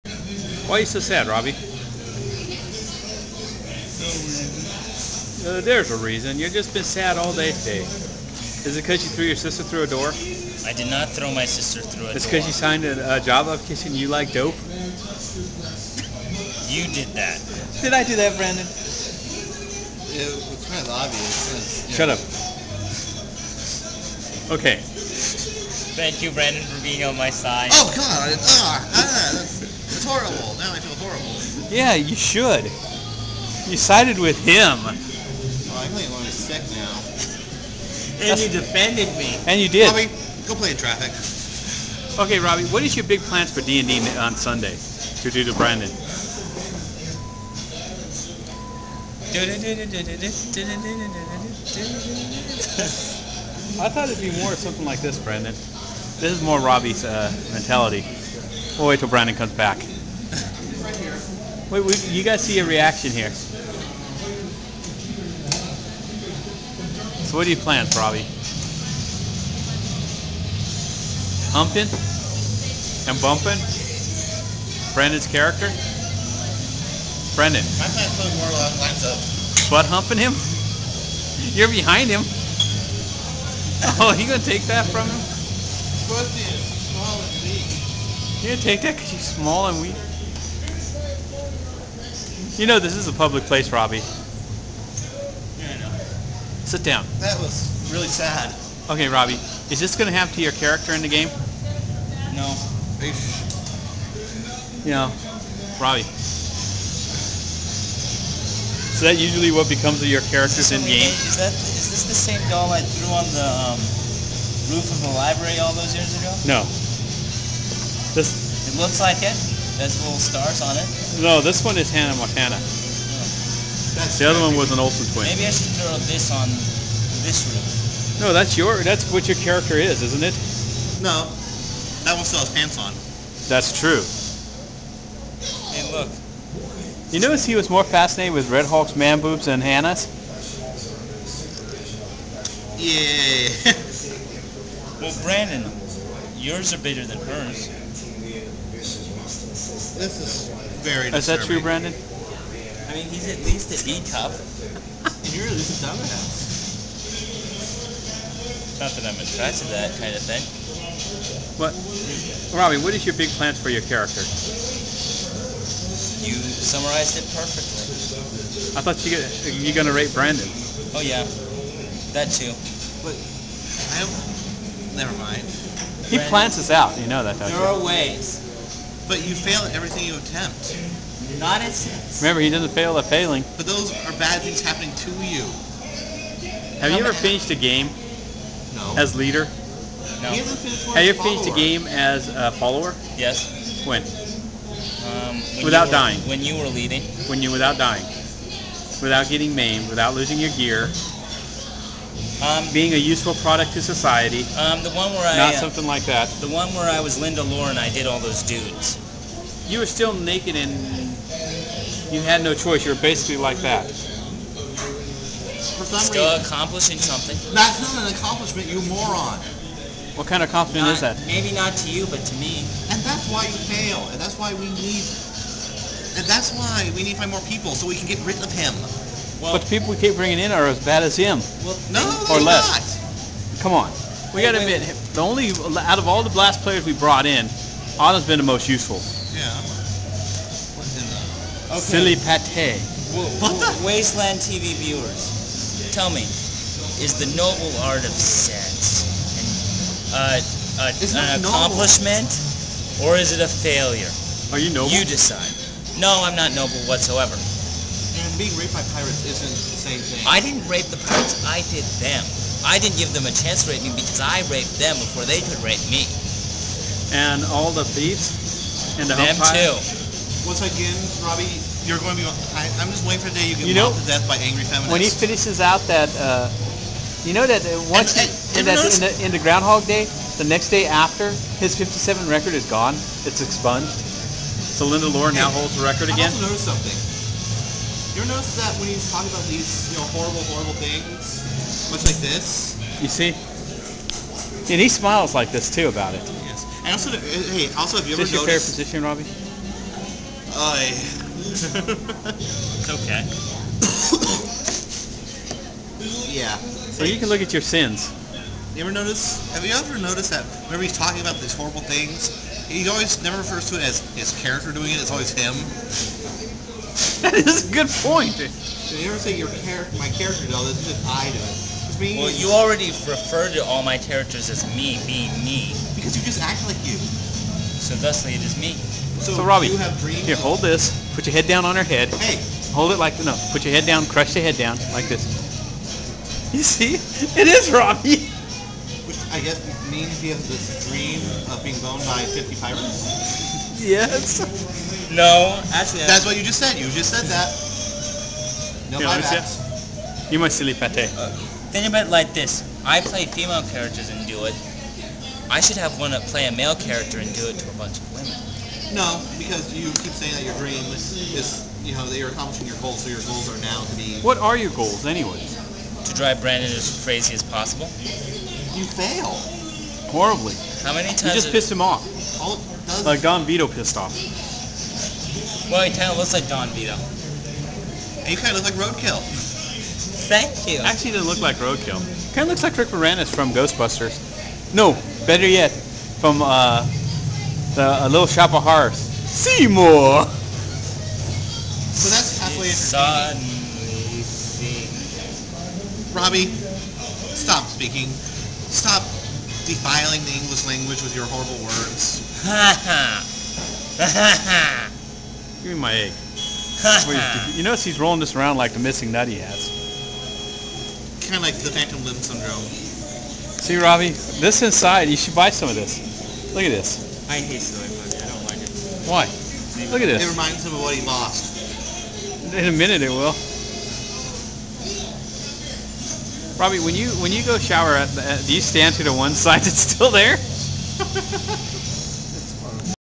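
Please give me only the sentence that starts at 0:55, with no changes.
This is more Robbie's uh, mentality.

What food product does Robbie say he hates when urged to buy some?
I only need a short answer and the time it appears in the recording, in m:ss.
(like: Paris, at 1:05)
Soy, at 6:57.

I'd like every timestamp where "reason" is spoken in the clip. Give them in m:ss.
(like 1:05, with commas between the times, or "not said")
0:06, 3:36.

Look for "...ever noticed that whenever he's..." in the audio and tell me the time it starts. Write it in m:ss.
5:09.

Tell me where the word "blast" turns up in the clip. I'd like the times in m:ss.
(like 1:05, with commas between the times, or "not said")
3:56.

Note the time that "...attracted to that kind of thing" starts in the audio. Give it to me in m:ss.
2:39.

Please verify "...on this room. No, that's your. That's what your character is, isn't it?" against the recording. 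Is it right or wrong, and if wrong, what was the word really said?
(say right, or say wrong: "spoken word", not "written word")
right.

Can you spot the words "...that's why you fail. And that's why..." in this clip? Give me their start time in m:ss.
3:43.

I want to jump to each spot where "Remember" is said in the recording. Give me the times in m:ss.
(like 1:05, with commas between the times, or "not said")
3:02.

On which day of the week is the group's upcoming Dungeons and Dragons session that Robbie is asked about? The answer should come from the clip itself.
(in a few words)
Sunday.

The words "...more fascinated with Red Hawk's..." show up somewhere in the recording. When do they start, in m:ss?
2:17.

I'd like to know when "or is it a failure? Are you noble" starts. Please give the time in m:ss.
4:13.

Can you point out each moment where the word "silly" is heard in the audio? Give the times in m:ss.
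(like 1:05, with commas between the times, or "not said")
4:01, 5:50.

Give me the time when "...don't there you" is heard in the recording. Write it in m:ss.
2:57.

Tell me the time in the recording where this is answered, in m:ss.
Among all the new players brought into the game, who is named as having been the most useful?
3:57.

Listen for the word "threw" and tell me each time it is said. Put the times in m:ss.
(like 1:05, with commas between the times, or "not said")
0:09, 1:52.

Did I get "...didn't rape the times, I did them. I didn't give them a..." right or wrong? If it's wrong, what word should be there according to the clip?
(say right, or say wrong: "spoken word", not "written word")
wrong: "pirates", not "times".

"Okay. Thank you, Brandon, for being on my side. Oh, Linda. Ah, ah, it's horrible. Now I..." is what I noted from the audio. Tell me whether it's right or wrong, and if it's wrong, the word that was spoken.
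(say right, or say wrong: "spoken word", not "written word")
wrong: "God", not "Linda".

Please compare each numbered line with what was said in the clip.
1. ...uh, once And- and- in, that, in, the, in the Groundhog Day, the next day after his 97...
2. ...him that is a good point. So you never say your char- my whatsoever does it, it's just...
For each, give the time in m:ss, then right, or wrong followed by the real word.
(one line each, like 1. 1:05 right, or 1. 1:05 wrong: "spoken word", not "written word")
1. 4:37 wrong: "57", not "97"
2. 5:15 wrong: "character", not "whatsoever".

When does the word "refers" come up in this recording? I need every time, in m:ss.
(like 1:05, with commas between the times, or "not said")
5:13, 5:23.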